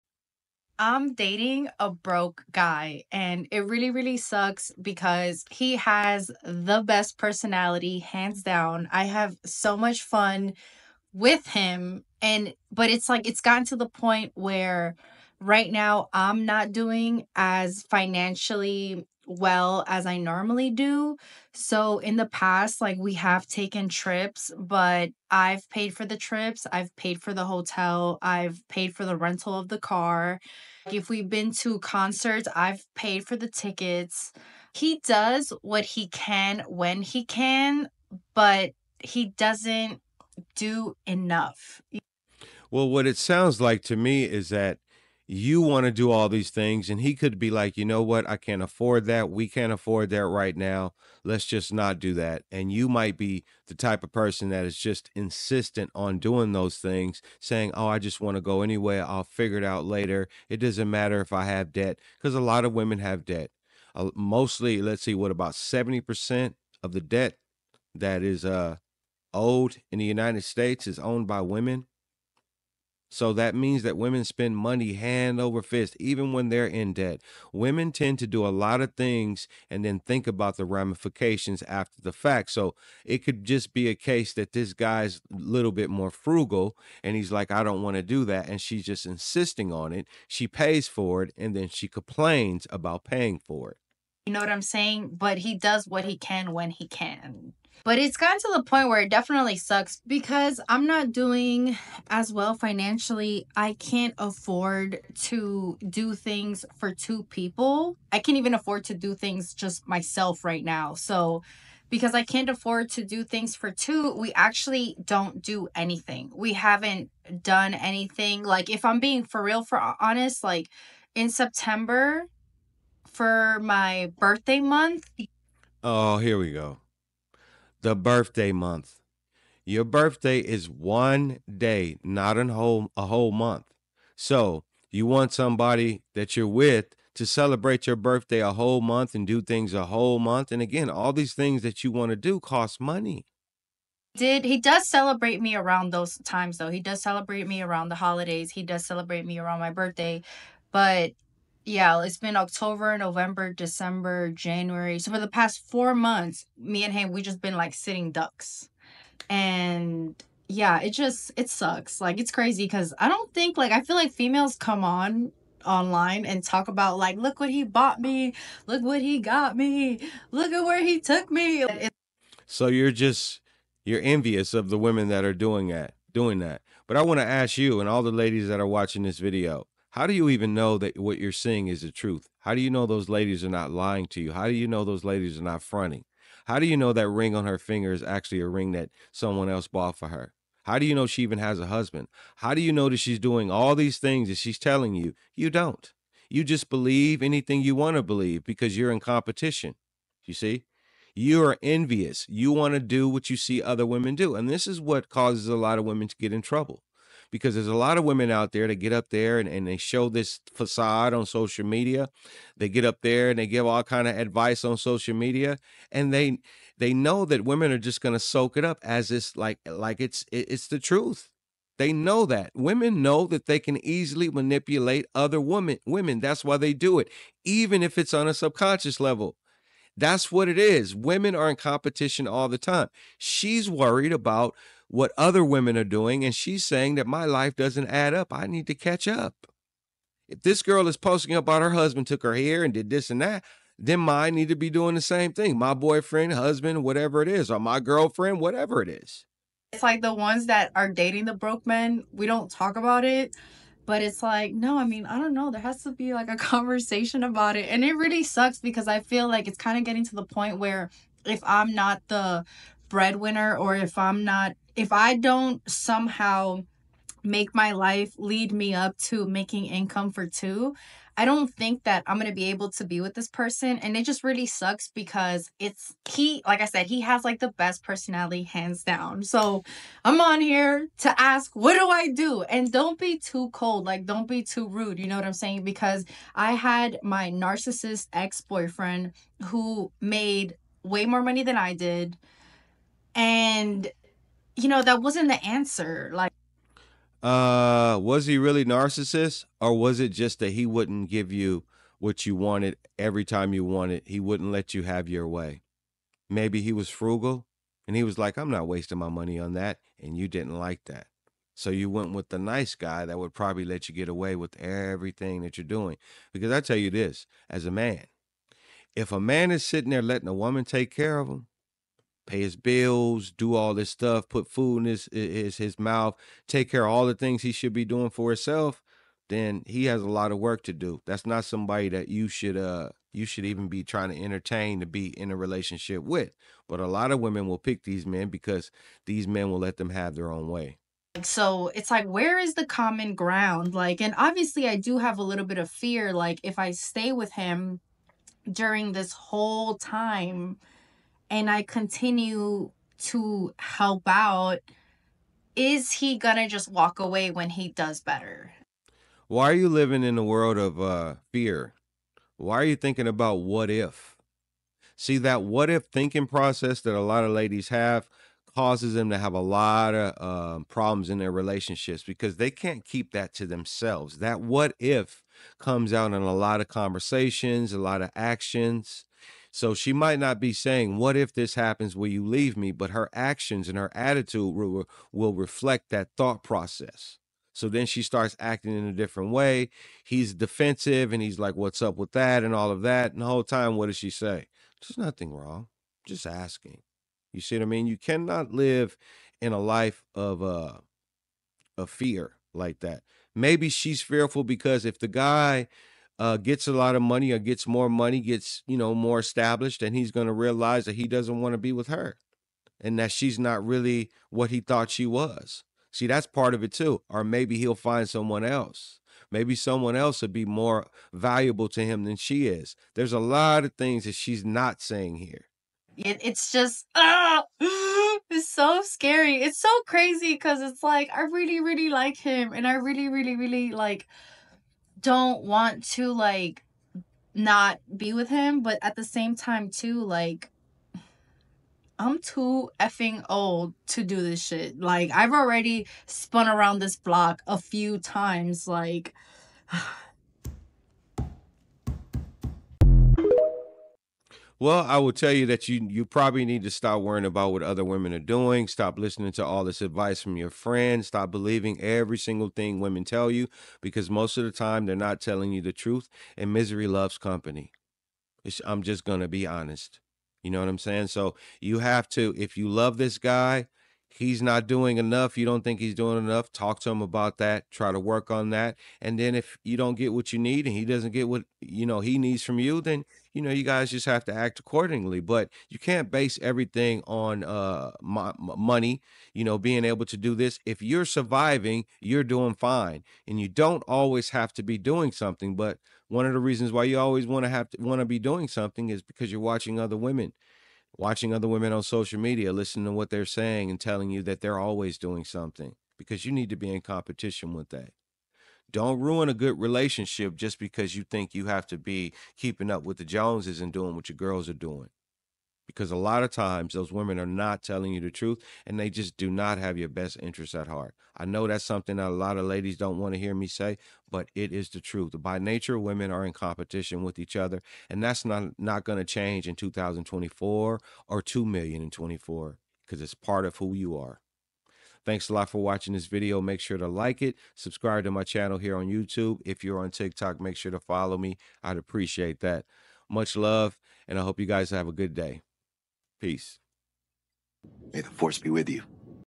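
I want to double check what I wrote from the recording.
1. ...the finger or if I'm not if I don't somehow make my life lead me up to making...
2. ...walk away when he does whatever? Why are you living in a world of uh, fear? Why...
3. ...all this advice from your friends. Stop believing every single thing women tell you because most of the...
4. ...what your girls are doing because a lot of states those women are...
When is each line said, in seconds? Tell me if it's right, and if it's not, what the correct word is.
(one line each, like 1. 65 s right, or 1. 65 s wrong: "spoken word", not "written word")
1. 262 s wrong: "breadwinner", not "finger"
2. 356 s wrong: "better", not "whatever"
3. 459 s right
4. 513 s wrong: "times", not "states".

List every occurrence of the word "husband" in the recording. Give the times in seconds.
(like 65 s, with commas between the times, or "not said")
191 s, 241 s, 246 s.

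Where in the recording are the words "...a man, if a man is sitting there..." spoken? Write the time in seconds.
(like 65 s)
317 s.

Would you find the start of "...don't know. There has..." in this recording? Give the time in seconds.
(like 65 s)
255 s.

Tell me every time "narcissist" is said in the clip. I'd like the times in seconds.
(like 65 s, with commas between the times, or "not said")
287 s, 298 s.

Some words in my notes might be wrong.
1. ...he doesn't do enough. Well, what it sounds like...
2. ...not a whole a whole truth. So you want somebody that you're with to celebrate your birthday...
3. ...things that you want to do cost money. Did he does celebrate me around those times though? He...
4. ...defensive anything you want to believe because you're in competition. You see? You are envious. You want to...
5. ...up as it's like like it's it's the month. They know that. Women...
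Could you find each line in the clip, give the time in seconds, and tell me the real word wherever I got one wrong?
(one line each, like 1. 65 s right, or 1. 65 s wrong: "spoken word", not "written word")
1. 38 s right
2. 132 s wrong: "month", not "truth"
3. 141 s right
4. 196 s wrong: "believe", not "defensive"
5. 218 s wrong: "truth", not "month".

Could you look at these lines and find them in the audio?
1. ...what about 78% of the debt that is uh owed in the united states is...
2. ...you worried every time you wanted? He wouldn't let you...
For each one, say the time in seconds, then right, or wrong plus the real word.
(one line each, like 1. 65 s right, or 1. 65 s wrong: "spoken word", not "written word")
1. 65 s wrong: "70", not "78"
2. 302 s wrong: "wanted", not "worried".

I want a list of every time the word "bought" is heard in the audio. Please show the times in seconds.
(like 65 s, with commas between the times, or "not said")
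167 s, 189 s.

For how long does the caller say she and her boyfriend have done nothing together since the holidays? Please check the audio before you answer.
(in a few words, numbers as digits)
4 months.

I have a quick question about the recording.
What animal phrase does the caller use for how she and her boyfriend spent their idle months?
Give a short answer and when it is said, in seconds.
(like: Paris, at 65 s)
sitting ducks, at 157 s.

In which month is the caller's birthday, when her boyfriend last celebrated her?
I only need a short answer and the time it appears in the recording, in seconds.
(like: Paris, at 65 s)
September, at 121 s.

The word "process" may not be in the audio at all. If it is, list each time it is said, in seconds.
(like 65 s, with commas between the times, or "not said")
366 s, 386 s.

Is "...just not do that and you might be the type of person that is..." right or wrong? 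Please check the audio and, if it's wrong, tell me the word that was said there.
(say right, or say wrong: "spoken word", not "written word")
right.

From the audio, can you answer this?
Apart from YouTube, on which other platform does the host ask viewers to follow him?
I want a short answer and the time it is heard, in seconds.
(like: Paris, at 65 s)
TikTok, at 539 s.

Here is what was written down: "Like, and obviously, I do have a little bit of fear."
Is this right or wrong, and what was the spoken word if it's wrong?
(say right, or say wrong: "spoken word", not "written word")
right.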